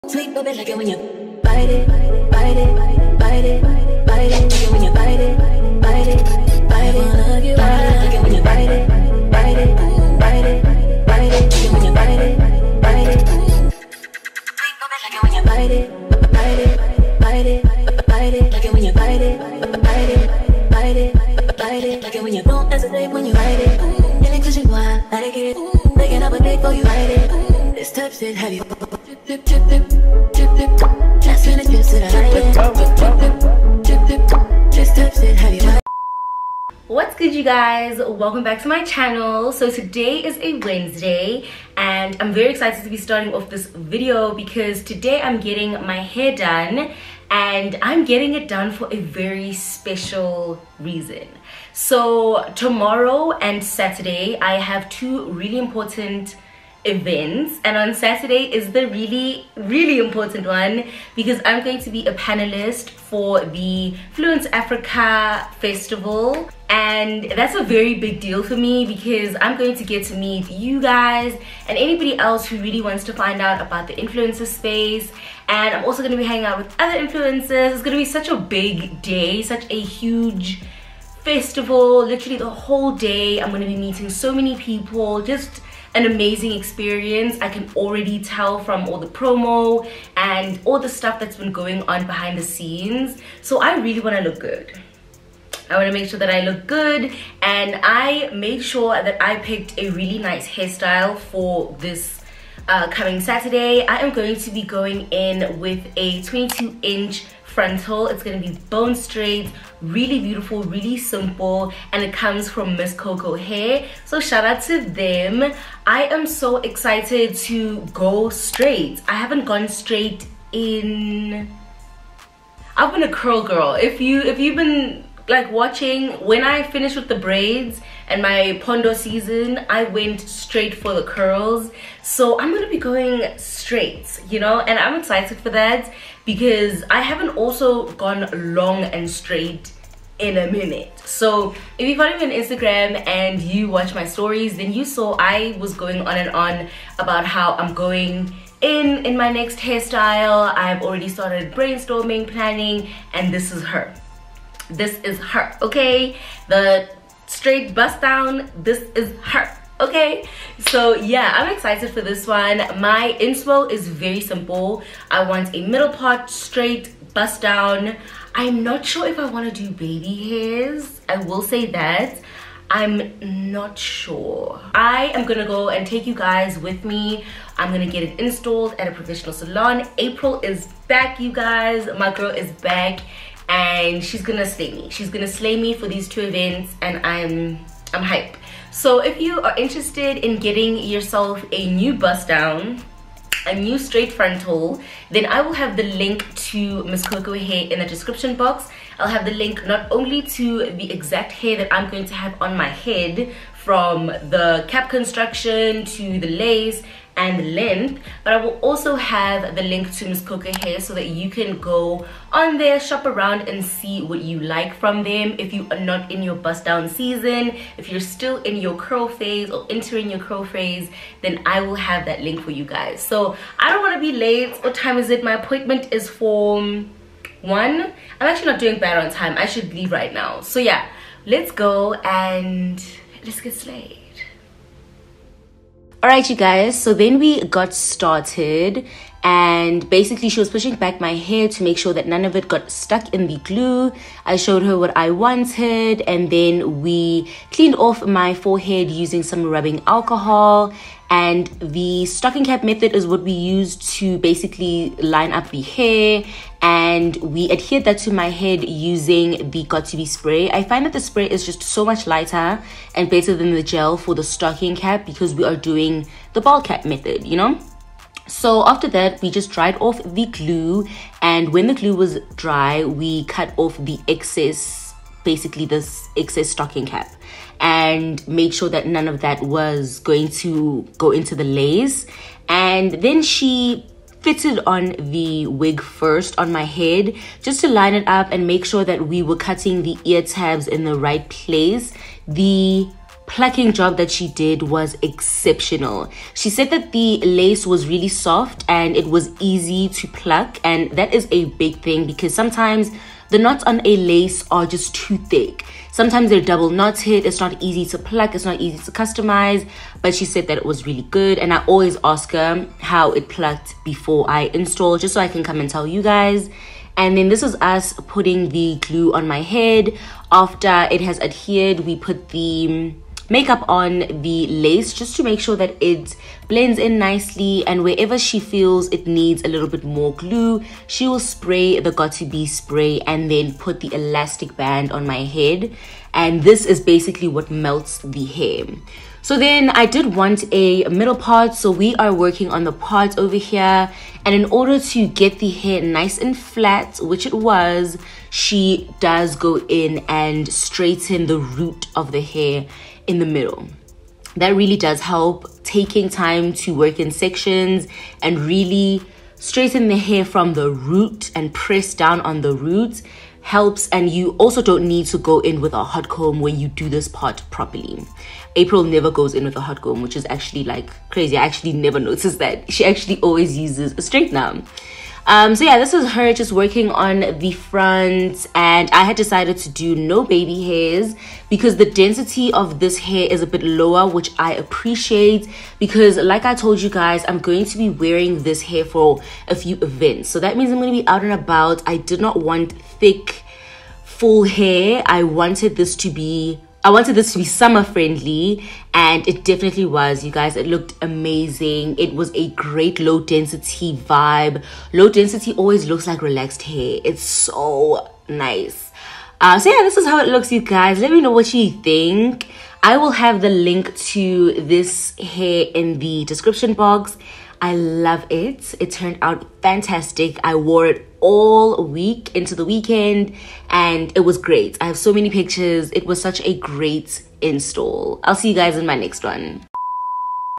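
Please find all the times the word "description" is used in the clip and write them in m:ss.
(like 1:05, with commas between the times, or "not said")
3:17, 6:56.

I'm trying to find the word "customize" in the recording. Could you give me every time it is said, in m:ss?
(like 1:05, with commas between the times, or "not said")
5:08.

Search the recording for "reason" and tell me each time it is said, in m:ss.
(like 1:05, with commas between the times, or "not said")
0:50.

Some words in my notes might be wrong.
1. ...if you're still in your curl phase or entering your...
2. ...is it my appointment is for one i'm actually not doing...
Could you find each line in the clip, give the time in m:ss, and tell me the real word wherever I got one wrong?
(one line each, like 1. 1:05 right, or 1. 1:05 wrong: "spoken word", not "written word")
1. 3:37 right
2. 3:44 right.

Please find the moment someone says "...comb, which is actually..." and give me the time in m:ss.
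6:09.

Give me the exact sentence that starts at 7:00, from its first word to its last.
I wore it all week into the weekend and it was great.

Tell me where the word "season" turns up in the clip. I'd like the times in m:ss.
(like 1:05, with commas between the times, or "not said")
2:08, 3:36.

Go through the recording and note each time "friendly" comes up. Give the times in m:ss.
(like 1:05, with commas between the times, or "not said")
6:37.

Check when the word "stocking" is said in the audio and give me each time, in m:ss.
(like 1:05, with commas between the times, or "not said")
4:12, 4:24, 4:36.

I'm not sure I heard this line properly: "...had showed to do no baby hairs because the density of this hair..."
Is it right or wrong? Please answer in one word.
wrong.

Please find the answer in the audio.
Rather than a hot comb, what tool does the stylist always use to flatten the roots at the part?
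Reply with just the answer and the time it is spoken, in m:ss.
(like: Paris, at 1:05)
Straightener, at 6:13.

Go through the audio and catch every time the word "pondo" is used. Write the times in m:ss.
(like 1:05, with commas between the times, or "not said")
2:08.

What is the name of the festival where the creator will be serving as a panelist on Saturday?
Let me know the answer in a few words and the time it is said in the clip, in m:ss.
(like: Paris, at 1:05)
Fluence Africa Festival, at 1:04.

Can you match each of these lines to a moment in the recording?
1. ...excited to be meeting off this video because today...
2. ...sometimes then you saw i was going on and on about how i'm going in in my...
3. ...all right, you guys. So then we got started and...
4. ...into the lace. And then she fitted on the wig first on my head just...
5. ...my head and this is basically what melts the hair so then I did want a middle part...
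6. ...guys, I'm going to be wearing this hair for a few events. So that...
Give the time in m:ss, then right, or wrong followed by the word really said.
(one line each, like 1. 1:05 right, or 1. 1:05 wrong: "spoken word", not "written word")
1. 0:42 wrong: "starting", not "meeting"
2. 2:24 wrong: "stories", not "sometimes"
3. 3:56 right
4. 4:41 right
5. 5:35 right
6. 6:26 right.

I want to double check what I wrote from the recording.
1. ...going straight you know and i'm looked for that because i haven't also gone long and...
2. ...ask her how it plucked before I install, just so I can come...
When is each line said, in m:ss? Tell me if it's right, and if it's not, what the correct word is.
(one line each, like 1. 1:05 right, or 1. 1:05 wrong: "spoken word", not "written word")
1. 2:12 wrong: "excited", not "looked"
2. 5:12 right.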